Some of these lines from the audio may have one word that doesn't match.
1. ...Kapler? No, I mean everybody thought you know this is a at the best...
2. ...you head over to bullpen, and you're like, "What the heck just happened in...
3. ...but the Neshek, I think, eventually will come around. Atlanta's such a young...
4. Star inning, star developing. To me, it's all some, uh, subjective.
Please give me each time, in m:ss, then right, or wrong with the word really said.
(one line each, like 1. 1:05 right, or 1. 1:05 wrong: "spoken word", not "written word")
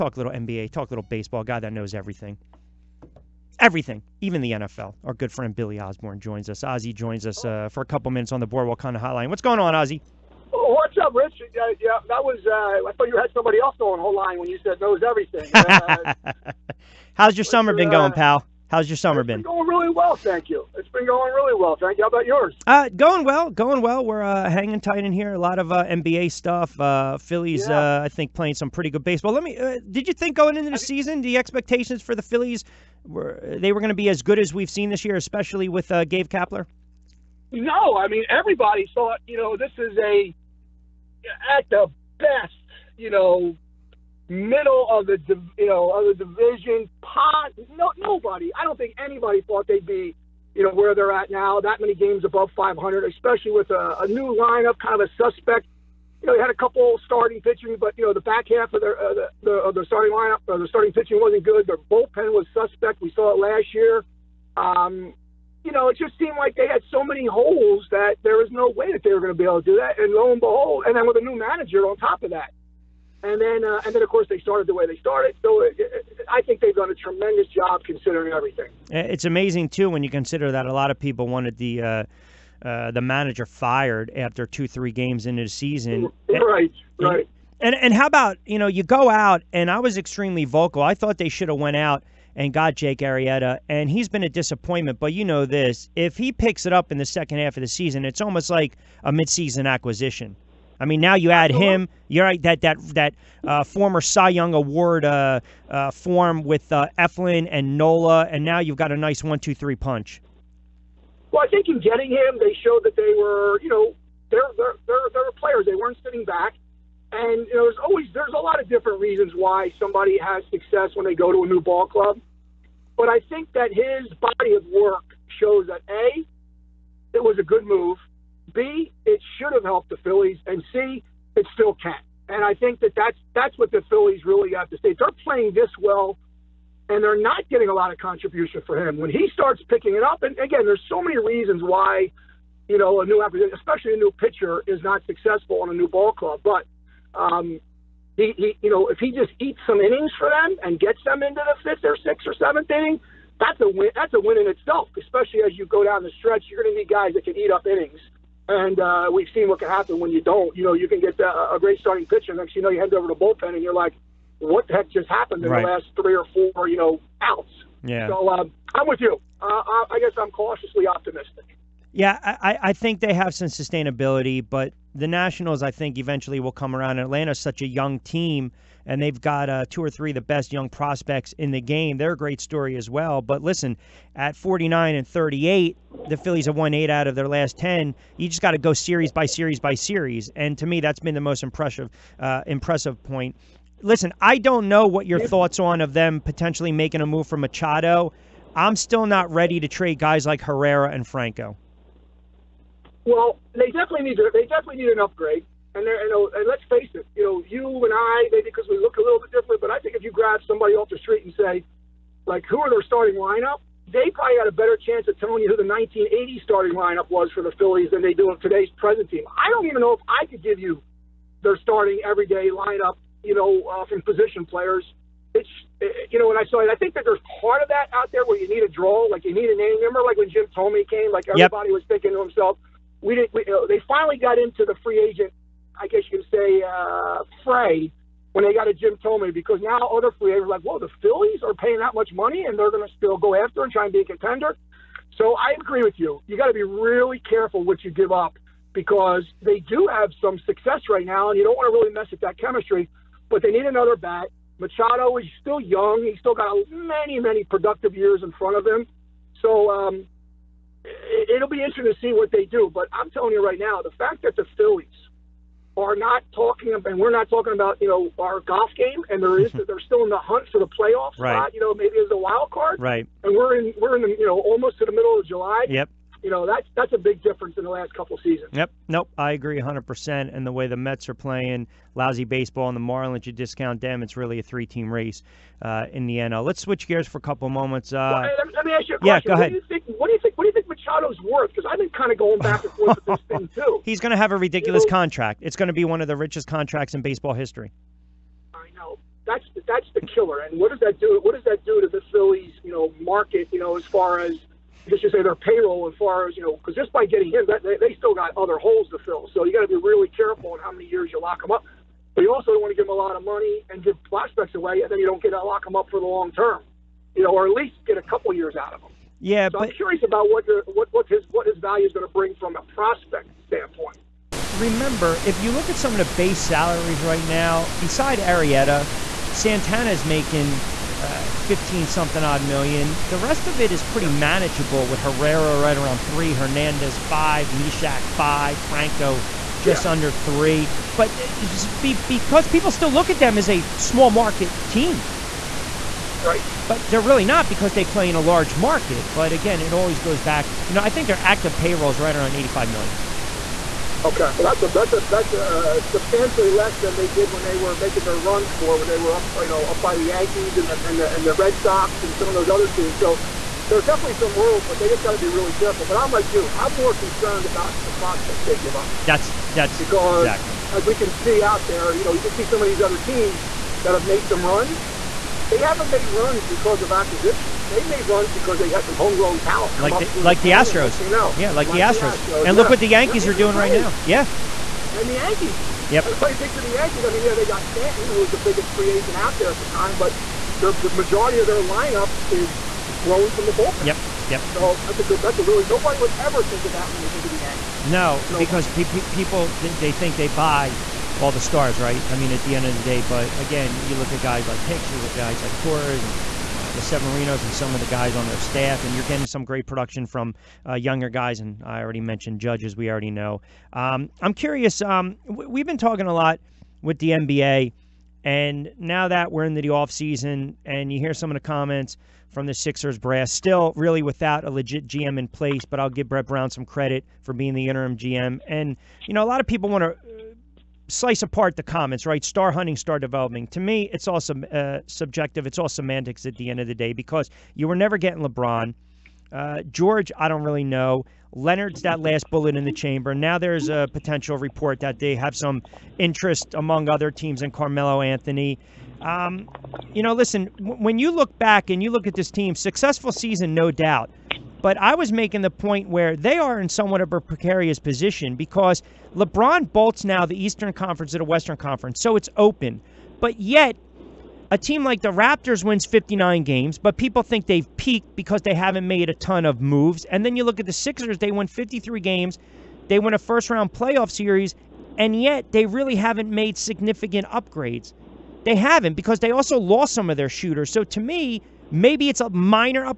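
1. 0:36 right
2. 2:42 right
3. 2:54 wrong: "Nationals", not "Neshek"
4. 7:12 wrong: "hunting", not "inning".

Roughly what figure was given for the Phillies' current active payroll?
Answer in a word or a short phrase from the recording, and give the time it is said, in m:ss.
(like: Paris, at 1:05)
85 million, at 5:52.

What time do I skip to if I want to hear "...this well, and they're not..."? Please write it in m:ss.
2:15.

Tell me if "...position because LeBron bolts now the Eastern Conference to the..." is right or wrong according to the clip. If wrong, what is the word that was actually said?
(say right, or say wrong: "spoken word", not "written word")
right.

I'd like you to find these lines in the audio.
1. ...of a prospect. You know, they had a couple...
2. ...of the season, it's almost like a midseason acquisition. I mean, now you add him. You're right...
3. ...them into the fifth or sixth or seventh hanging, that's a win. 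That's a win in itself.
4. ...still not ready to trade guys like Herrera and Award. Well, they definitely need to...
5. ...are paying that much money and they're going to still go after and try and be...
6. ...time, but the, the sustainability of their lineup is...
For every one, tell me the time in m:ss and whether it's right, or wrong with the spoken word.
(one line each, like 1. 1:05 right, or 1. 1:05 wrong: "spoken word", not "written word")
1. 0:54 wrong: "suspect", not "prospect"
2. 1:37 right
3. 2:31 wrong: "inning", not "hanging"
4. 3:18 wrong: "Franco", not "Award"
5. 4:01 right
6. 6:29 wrong: "majority", not "sustainability".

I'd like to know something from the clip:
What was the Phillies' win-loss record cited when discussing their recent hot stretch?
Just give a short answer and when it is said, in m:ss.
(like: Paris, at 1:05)
49 and 38, at 3:04.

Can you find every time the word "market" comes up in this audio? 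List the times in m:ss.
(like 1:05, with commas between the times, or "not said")
5:02, 5:44, 5:48.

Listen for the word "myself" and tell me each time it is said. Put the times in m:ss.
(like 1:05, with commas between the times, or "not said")
not said.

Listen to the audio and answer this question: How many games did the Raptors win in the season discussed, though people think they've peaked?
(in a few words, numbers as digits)
59.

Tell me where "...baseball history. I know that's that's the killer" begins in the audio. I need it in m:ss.
4:57.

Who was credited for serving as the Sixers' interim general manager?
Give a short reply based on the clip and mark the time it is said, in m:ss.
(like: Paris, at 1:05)
Brett Brown, at 7:06.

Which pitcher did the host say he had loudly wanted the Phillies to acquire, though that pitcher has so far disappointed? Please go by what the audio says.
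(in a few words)
Jake Arrieta.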